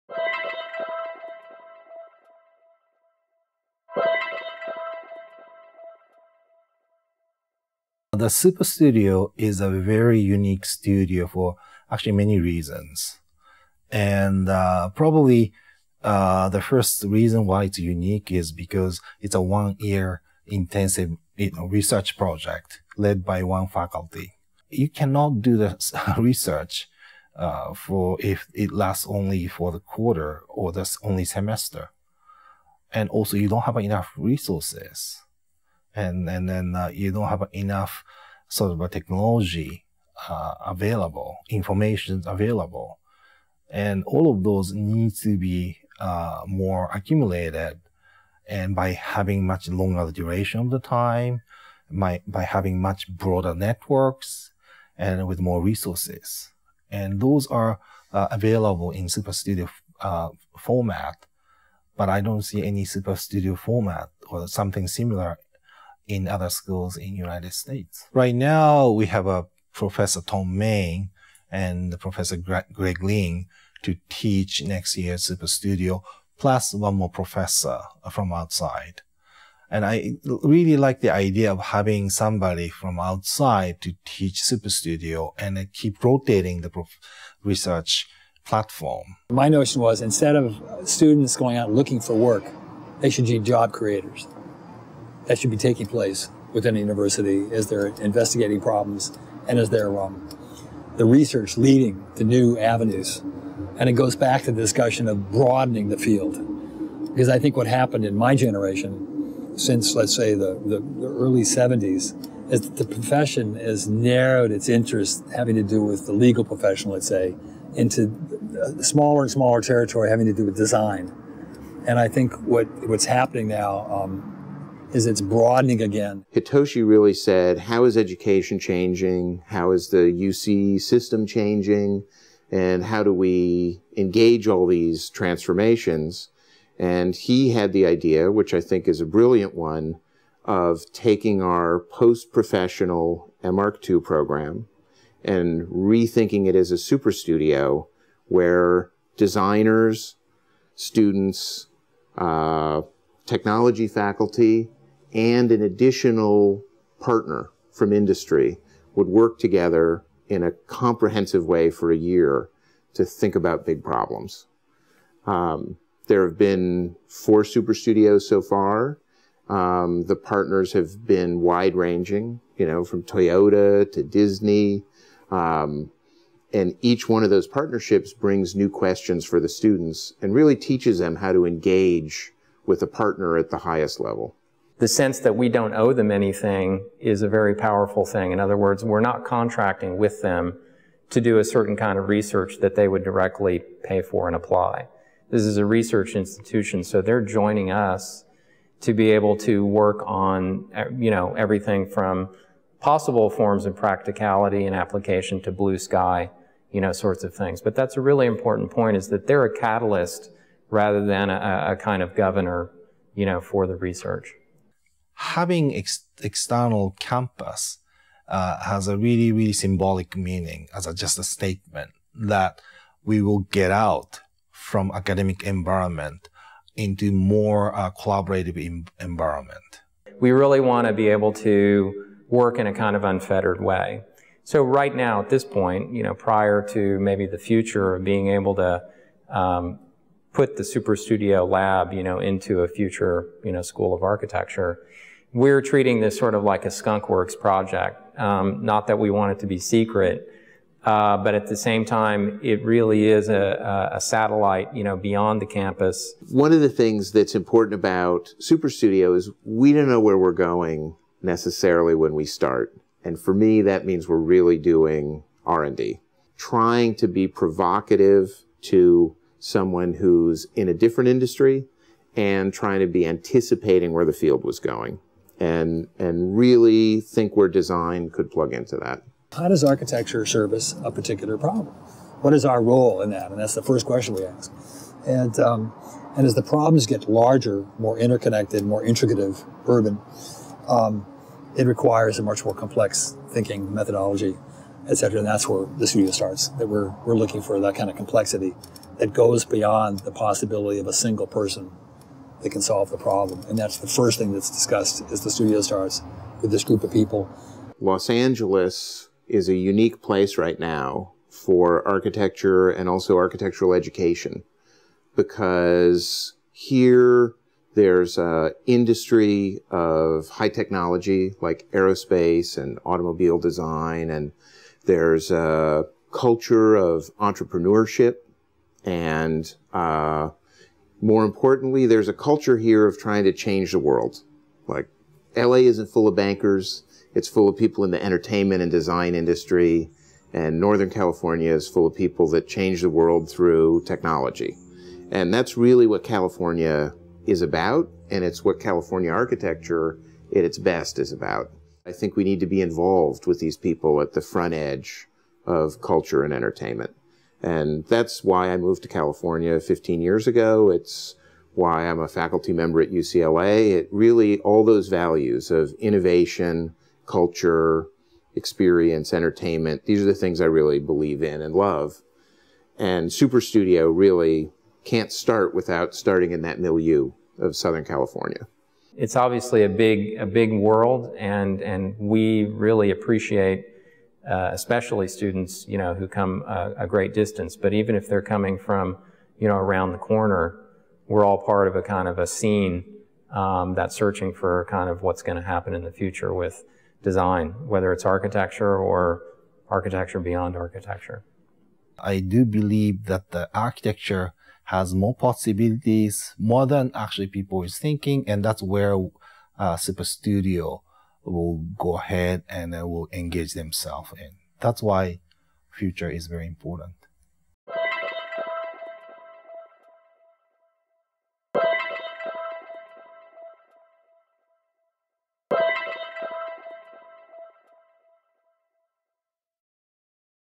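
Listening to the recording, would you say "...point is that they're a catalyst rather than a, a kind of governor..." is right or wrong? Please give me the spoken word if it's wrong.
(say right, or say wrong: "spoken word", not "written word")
right.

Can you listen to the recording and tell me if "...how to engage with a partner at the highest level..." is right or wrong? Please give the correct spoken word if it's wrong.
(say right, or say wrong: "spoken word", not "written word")
right.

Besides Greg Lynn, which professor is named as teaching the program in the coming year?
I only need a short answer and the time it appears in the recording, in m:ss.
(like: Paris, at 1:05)
Thom Mayne, at 1:10.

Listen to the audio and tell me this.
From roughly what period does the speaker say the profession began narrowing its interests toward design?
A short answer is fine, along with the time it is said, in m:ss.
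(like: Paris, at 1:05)
early 70s, at 1:51.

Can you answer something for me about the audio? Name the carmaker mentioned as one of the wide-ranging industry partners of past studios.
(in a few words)
Toyota.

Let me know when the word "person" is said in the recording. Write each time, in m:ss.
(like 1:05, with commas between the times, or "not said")
5:01.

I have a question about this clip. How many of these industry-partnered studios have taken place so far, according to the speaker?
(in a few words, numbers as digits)
4.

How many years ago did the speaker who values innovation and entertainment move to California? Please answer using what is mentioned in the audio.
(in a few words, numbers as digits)
15.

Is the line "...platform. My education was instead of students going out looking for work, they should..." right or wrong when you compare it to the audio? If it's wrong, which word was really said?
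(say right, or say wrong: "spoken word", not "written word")
wrong: "notion", not "education".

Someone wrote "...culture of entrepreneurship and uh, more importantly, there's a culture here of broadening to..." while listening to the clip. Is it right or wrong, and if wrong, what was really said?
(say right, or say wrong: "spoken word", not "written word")
wrong: "trying", not "broadening".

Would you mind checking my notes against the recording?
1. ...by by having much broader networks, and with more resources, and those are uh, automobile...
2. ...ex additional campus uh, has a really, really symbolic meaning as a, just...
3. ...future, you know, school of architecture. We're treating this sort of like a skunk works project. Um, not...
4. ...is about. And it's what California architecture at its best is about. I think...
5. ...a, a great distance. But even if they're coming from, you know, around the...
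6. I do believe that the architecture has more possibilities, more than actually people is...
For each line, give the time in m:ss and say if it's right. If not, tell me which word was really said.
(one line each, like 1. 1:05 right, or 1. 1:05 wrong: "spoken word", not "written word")
1. 0:51 wrong: "available", not "automobile"
2. 3:35 wrong: "external", not "additional"
3. 4:02 right
4. 5:47 right
5. 6:26 right
6. 6:41 right.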